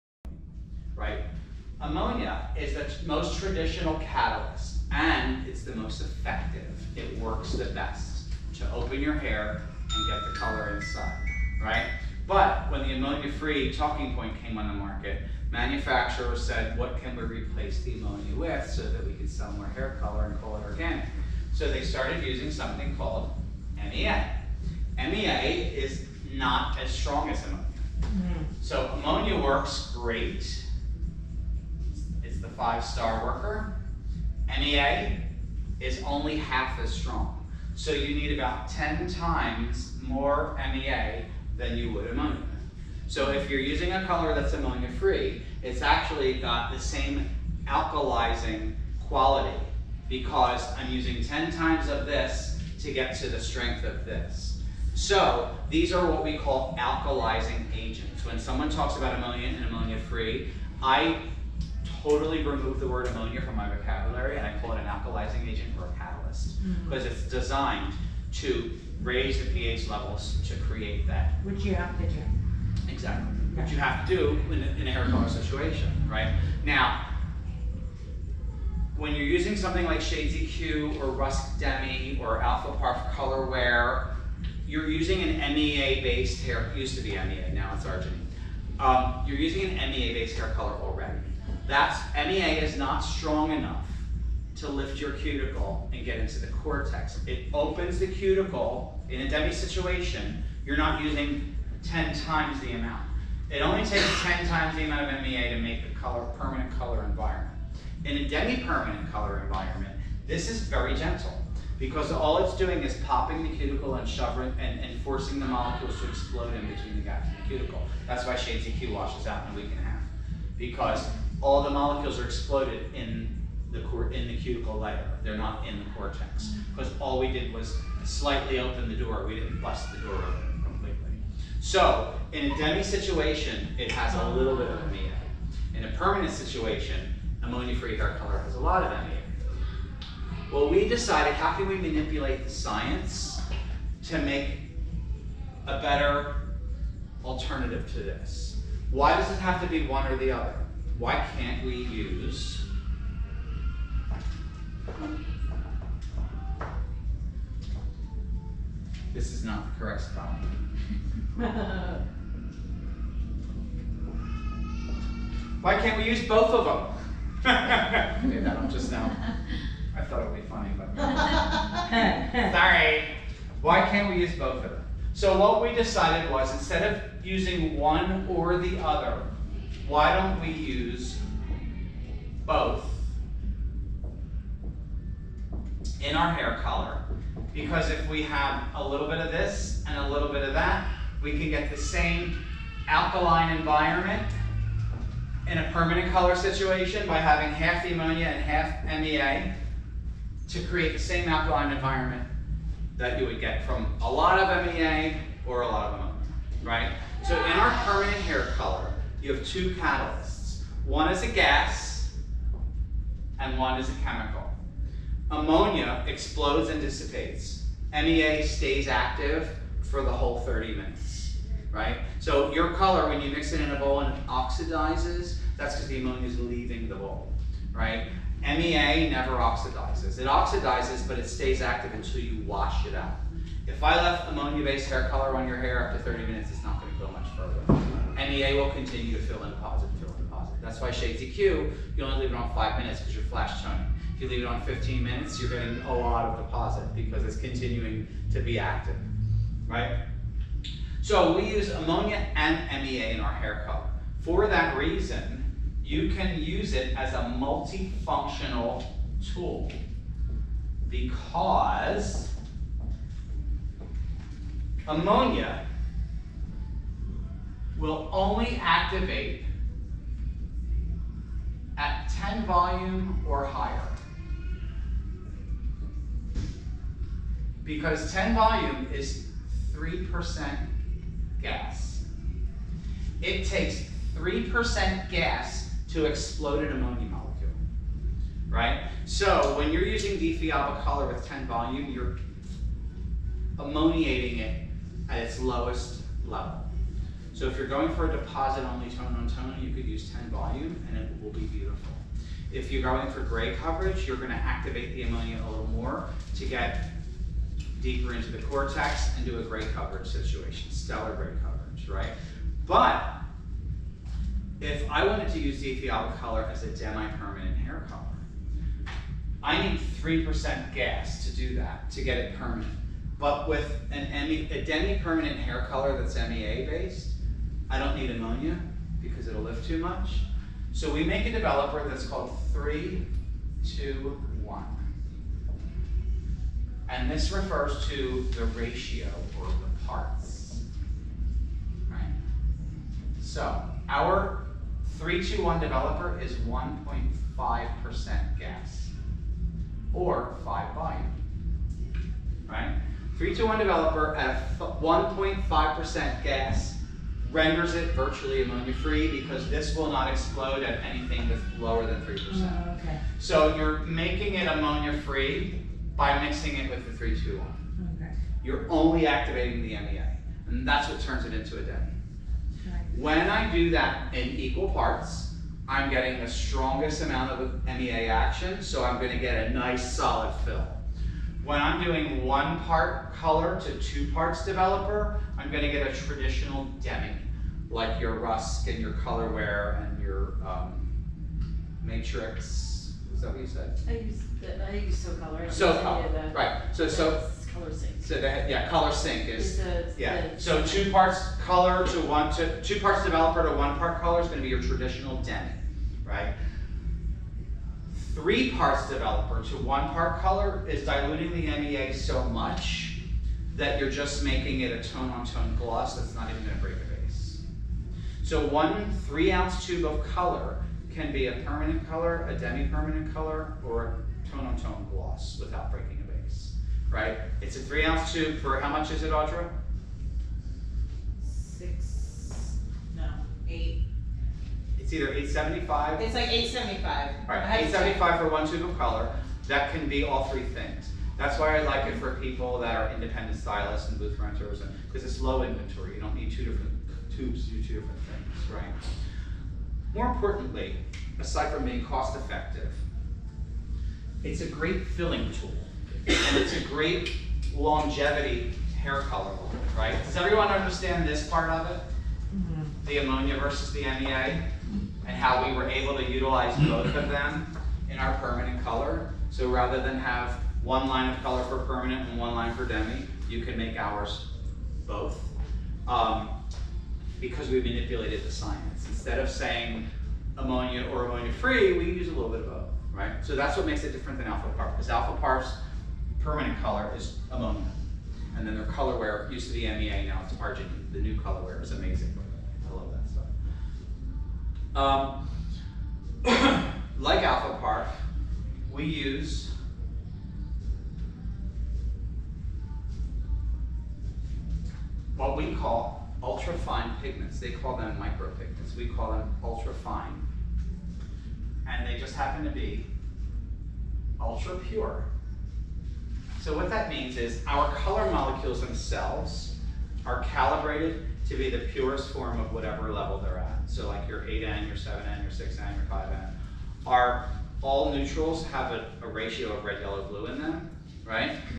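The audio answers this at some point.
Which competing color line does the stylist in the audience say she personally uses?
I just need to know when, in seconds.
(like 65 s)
394 s.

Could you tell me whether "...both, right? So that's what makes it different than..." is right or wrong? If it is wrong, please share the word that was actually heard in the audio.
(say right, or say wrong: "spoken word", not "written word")
right.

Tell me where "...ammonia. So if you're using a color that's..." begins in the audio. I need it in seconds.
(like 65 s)
42 s.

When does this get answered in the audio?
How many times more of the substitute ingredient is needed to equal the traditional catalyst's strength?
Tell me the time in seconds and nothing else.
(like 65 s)
38 s.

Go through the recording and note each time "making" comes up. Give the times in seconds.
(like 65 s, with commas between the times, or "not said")
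363 s, 414 s.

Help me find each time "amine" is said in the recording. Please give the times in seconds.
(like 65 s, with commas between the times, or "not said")
134 s, 138 s.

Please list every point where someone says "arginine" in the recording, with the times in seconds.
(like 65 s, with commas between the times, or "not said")
87 s, 490 s.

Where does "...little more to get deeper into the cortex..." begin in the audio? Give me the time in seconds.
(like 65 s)
305 s.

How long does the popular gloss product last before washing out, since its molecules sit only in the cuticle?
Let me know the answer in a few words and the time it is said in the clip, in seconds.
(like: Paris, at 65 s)
a week and a half, at 119 s.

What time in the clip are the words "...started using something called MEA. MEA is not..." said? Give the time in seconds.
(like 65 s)
21 s.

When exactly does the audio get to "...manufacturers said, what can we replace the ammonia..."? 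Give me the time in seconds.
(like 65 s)
15 s.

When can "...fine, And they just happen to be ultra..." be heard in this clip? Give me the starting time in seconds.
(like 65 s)
509 s.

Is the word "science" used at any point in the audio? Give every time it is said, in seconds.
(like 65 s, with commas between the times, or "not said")
142 s, 478 s.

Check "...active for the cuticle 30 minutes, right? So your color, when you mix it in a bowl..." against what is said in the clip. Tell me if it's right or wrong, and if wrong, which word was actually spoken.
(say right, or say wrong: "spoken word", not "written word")
wrong: "whole", not "cuticle".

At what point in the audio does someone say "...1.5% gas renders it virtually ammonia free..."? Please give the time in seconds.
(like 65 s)
354 s.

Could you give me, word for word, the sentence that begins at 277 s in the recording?
Because 10 volume is 3% gas.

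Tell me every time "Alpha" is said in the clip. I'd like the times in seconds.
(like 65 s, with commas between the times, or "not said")
82 s.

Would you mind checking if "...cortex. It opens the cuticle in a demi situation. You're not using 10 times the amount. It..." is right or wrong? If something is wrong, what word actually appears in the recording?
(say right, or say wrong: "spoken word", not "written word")
right.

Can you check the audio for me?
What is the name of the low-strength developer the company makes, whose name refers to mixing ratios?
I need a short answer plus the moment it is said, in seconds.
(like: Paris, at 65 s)
321, at 332 s.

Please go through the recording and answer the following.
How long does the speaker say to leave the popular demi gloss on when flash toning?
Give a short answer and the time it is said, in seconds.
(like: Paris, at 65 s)
5 minutes, at 242 s.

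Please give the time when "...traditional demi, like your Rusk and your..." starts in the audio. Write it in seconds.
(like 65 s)
385 s.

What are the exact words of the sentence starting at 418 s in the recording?
So one three-ounce tube of color can be a permanent color, a demi-permanent color, or a tone-on-tone gloss without breaking right?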